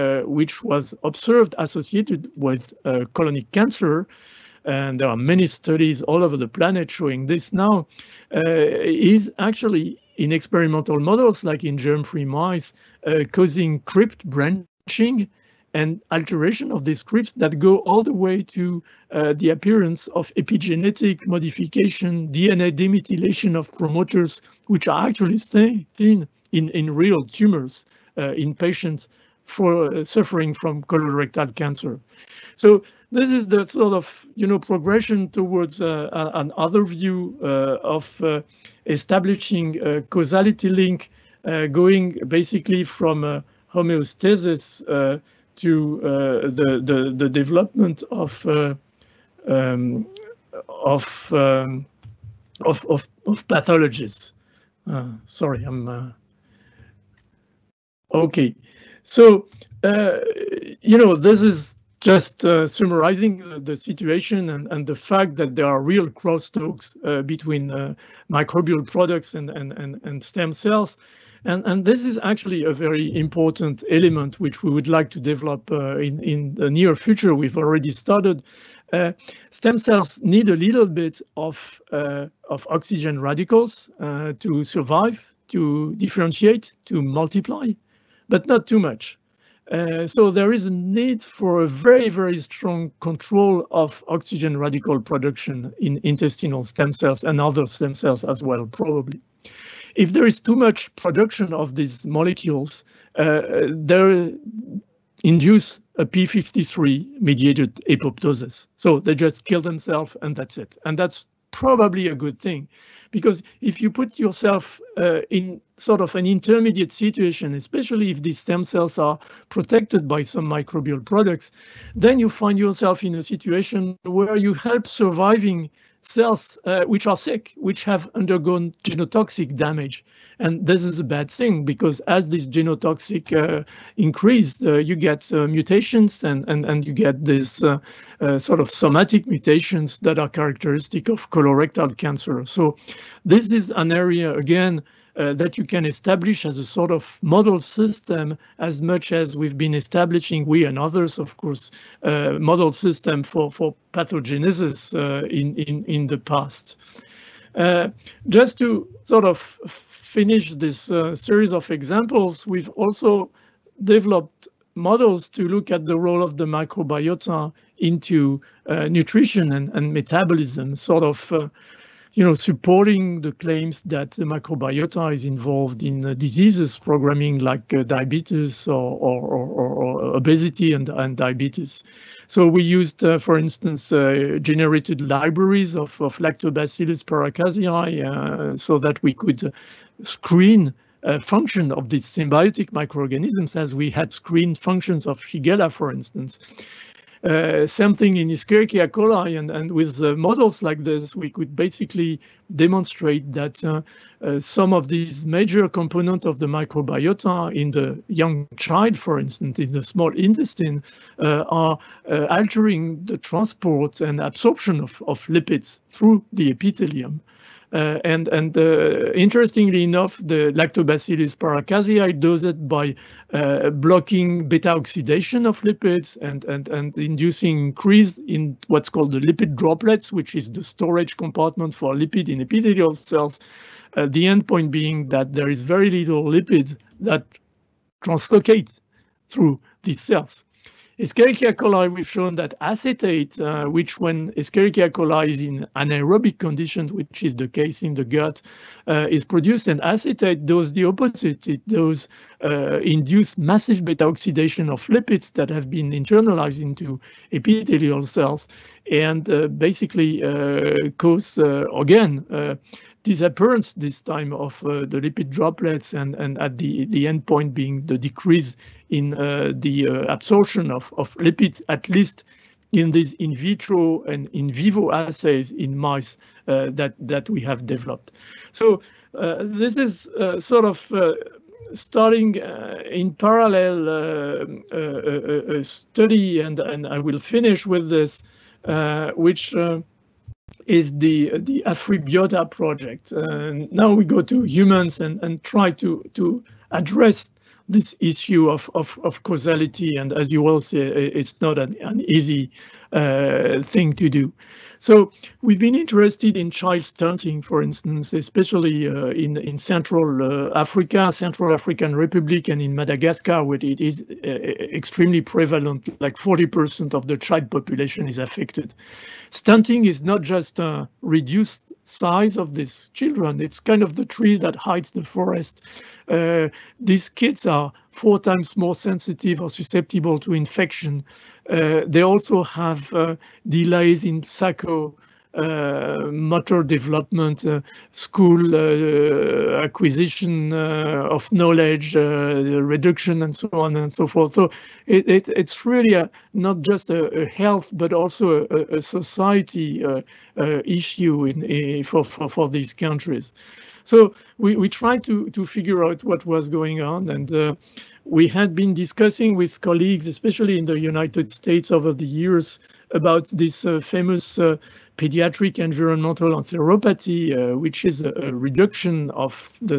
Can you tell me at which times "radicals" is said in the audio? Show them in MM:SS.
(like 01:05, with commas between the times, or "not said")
01:23, 01:34.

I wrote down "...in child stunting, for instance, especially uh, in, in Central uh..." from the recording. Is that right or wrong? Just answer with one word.
right.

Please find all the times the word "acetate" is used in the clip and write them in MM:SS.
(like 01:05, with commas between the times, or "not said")
04:02, 04:09.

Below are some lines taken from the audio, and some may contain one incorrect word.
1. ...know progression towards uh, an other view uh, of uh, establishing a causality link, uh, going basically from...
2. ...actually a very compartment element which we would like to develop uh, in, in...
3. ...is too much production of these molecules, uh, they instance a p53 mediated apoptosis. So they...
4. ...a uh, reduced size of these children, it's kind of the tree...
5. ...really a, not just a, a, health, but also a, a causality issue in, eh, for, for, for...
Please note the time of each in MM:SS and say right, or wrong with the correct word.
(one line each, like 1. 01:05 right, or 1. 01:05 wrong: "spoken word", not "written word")
1. 00:34 right
2. 01:12 wrong: "important", not "compartment"
3. 01:40 wrong: "induce", not "instance"
4. 05:20 right
5. 05:45 wrong: "society", not "causality".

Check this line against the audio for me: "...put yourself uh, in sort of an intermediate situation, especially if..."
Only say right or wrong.
right.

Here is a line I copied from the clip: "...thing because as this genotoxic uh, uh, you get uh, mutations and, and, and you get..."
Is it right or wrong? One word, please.
right.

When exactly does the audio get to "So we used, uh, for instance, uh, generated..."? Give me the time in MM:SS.
03:02.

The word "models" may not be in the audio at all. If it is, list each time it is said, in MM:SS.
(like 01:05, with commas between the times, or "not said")
00:10, 02:27, 02:32, 02:44, 03:20.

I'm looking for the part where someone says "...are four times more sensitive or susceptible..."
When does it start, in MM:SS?
05:27.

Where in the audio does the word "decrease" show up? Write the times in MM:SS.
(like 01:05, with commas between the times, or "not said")
04:27.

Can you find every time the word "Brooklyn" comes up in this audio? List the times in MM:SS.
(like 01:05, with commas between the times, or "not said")
not said.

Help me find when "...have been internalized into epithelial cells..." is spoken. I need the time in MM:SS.
04:15.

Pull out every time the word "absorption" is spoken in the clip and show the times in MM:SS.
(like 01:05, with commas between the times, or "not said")
03:34, 04:30.